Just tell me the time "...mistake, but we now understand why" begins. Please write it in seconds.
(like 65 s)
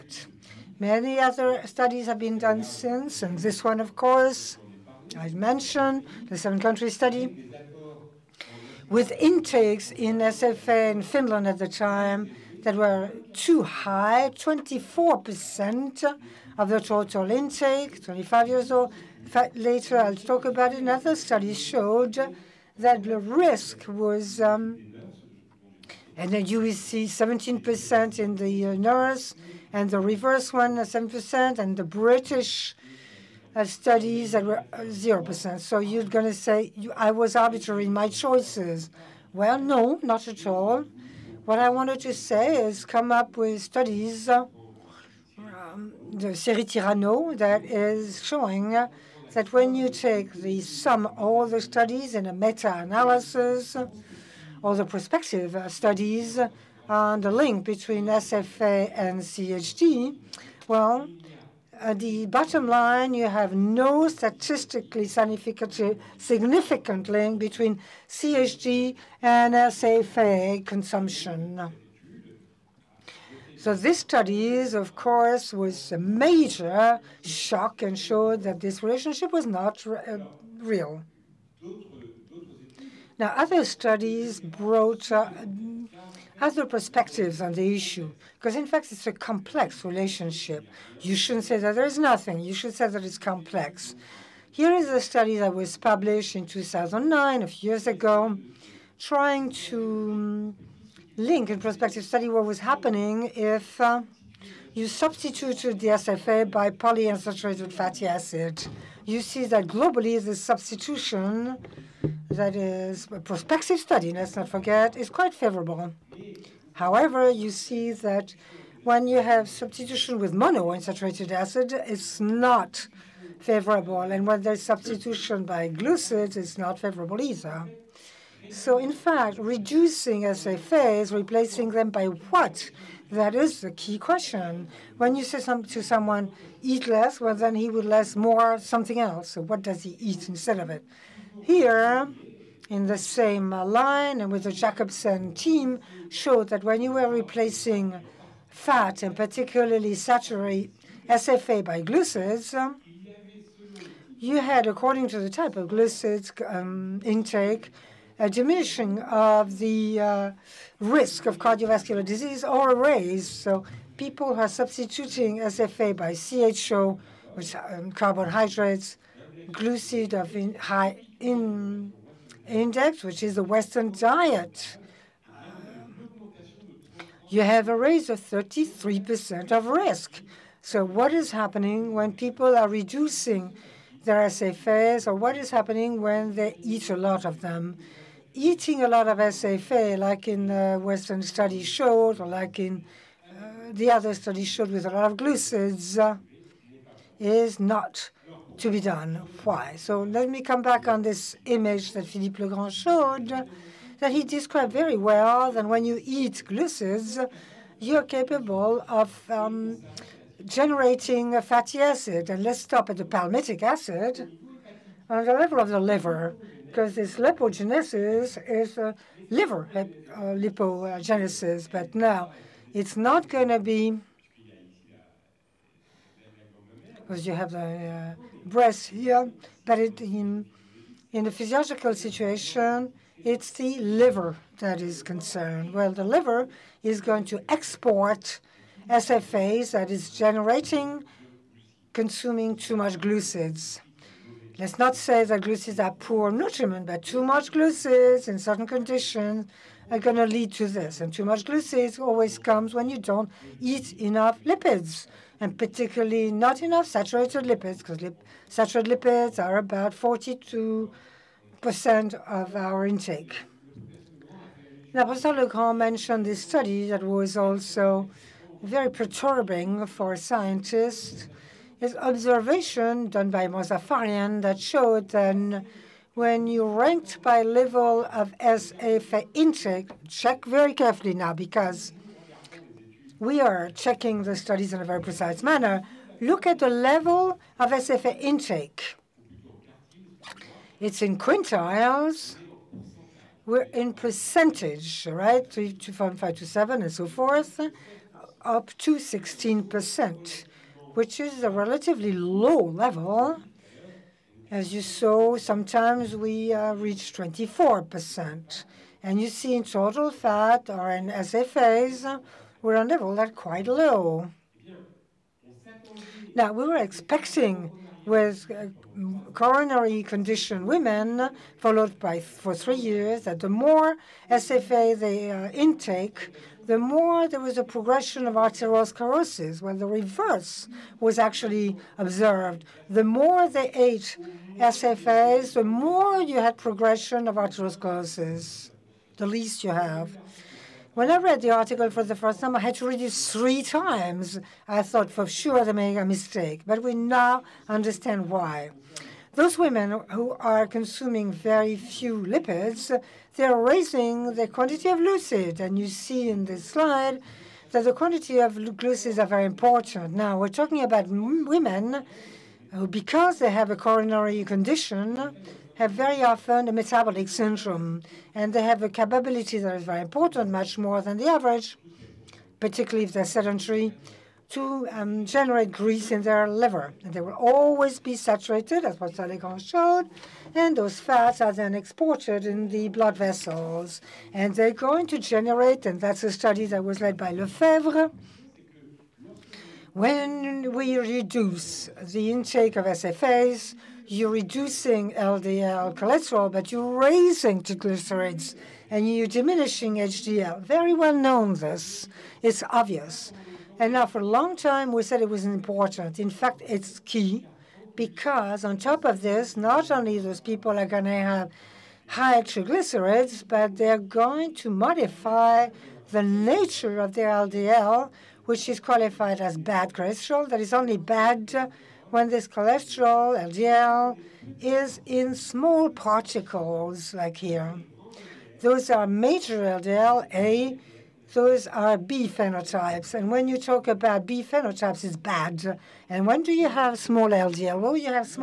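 346 s.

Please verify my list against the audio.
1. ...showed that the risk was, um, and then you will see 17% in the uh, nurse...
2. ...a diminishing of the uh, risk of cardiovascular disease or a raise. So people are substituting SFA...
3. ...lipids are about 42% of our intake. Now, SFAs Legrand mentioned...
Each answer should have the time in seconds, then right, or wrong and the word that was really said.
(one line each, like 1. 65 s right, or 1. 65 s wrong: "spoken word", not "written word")
1. 21 s right
2. 158 s right
3. 259 s wrong: "Professor", not "SFAs".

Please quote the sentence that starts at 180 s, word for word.
So what is happening when people are reducing their SFAs, or what is happening when they eat a lot of them?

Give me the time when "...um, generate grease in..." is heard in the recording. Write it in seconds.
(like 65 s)
374 s.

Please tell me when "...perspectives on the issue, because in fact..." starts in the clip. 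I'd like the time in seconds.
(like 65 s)
86 s.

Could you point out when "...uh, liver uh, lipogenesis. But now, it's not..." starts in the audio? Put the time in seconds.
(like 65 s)
218 s.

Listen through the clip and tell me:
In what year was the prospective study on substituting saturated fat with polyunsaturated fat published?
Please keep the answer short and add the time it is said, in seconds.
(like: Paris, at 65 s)
2009, at 96 s.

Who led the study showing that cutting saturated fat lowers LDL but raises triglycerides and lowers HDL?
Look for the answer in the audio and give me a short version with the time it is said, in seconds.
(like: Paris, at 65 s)
Lefebvre, at 387 s.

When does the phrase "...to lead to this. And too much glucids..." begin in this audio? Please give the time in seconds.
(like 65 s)
250 s.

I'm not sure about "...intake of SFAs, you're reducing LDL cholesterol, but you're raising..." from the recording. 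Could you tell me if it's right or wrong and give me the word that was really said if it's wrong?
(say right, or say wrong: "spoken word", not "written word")
right.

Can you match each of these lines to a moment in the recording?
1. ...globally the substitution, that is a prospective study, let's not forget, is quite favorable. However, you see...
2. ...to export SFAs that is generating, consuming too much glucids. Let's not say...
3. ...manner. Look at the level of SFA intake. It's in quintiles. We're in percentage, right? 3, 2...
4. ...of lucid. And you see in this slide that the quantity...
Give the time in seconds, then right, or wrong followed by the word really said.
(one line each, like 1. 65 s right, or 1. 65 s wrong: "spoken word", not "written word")
1. 109 s right
2. 237 s right
3. 285 s right
4. 354 s right.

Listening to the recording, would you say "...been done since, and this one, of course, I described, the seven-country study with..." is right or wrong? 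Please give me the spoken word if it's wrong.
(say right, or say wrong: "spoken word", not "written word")
wrong: "mentioned", not "described".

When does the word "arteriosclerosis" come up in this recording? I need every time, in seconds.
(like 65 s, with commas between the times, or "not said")
328 s, 337 s.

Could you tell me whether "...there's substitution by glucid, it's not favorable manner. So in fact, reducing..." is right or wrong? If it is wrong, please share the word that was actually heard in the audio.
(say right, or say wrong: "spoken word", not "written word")
wrong: "either", not "manner".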